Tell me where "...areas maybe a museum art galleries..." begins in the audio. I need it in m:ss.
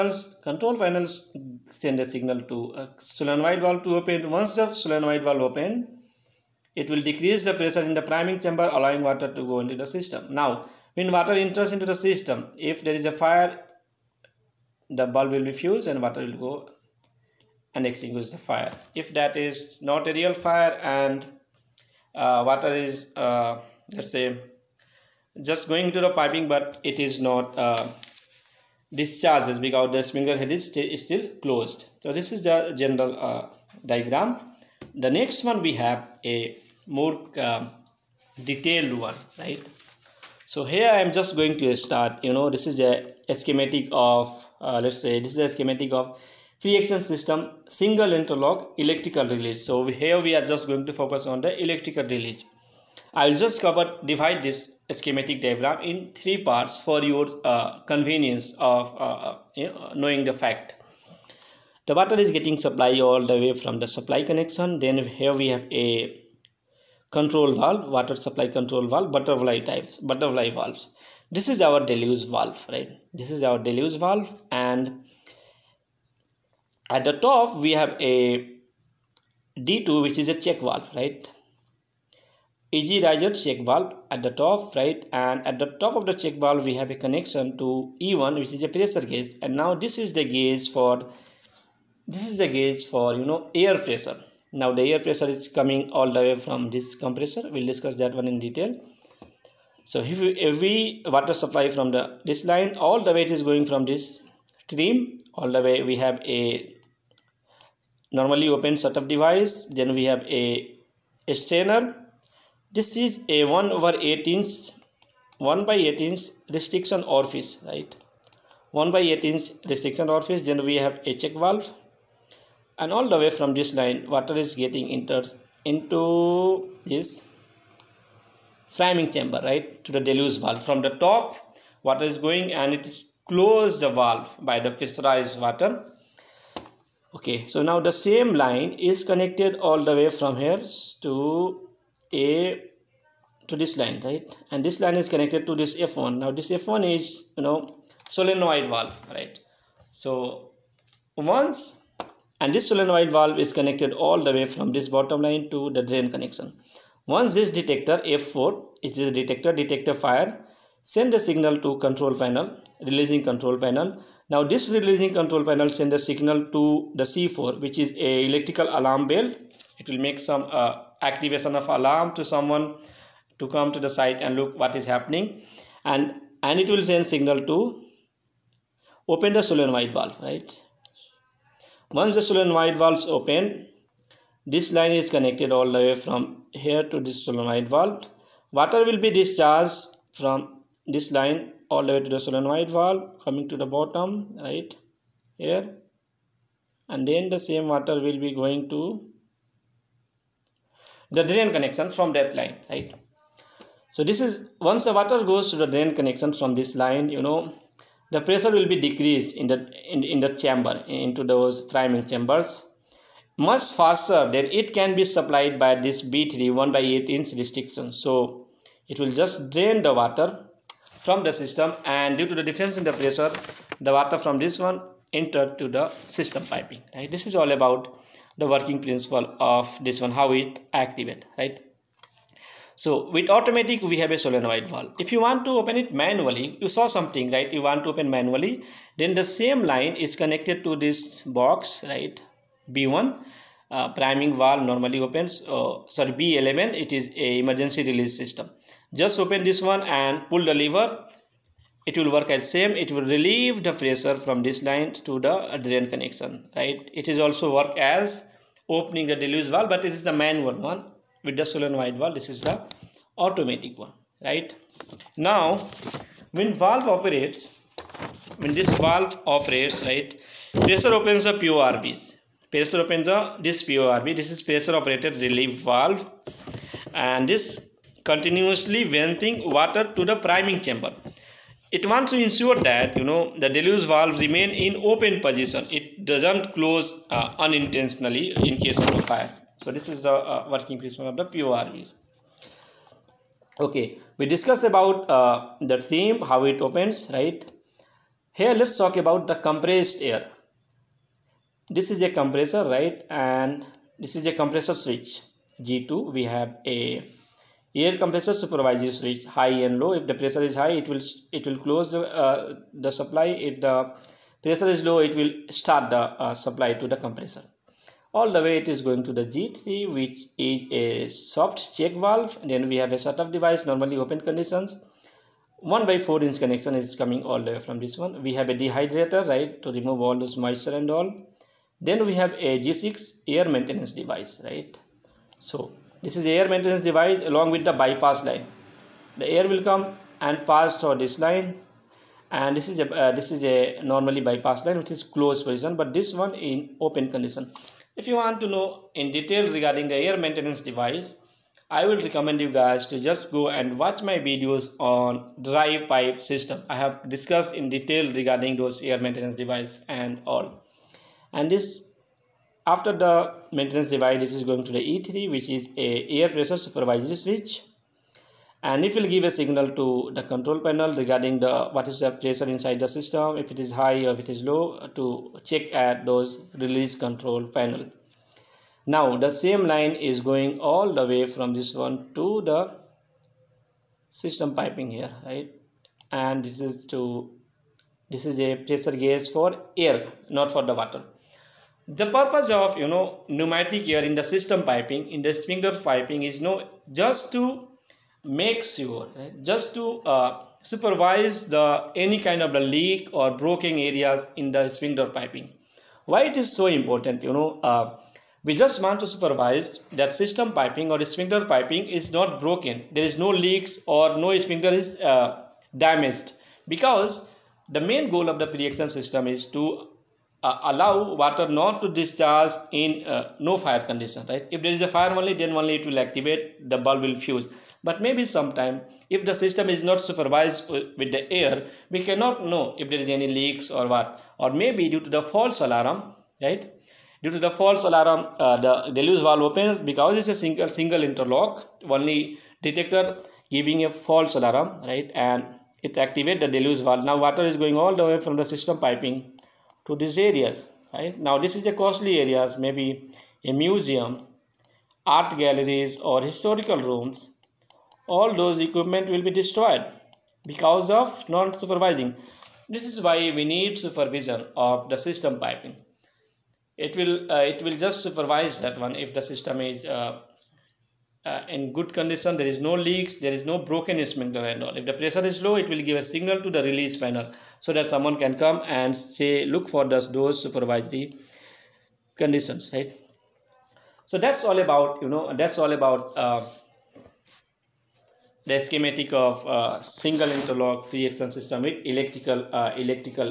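7:32.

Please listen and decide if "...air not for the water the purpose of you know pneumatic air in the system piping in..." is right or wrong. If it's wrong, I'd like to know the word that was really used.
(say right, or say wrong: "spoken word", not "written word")
right.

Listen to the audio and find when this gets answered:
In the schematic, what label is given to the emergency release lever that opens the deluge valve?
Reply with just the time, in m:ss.
4:06.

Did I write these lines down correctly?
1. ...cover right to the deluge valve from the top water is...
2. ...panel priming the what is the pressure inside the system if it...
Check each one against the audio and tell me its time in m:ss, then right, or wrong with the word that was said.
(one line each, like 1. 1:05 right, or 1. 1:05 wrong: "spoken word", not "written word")
1. 2:09 wrong: "chamber", not "cover"
2. 6:10 wrong: "regarding", not "priming".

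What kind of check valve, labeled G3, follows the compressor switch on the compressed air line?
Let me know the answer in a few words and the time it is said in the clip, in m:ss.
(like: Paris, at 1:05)
Soft check valve, at 5:21.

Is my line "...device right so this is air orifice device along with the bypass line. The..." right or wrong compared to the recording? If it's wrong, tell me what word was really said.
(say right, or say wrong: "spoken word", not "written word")
wrong: "maintenance", not "orifice".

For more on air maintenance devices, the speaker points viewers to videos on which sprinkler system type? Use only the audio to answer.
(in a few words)
Dry pipe system.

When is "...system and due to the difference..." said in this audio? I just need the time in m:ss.
3:41.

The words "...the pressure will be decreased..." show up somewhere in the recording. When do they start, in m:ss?
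3:28.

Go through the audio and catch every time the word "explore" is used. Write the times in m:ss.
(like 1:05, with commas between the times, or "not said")
not said.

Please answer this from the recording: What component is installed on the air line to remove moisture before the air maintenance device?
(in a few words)
Dehydrator.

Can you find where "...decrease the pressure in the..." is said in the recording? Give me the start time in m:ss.
0:07.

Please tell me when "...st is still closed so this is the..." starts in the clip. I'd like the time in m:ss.
0:30.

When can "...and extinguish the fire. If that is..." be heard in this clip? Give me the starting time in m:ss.
0:17.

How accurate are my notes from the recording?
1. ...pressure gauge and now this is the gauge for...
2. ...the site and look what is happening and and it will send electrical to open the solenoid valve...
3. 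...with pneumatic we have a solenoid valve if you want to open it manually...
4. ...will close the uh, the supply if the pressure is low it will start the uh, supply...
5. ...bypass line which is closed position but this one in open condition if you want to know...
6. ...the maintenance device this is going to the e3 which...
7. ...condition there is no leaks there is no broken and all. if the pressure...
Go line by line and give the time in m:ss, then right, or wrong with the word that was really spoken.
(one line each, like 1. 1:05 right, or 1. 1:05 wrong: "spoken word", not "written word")
1. 1:28 right
2. 2:53 wrong: "signal", not "electrical"
3. 3:53 wrong: "automatic", not "pneumatic"
4. 5:11 right
5. 5:44 right
6. 6:02 right
7. 7:51 right.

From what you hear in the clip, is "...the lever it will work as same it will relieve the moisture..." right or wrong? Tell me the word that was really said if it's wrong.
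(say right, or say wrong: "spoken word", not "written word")
wrong: "pressure", not "moisture".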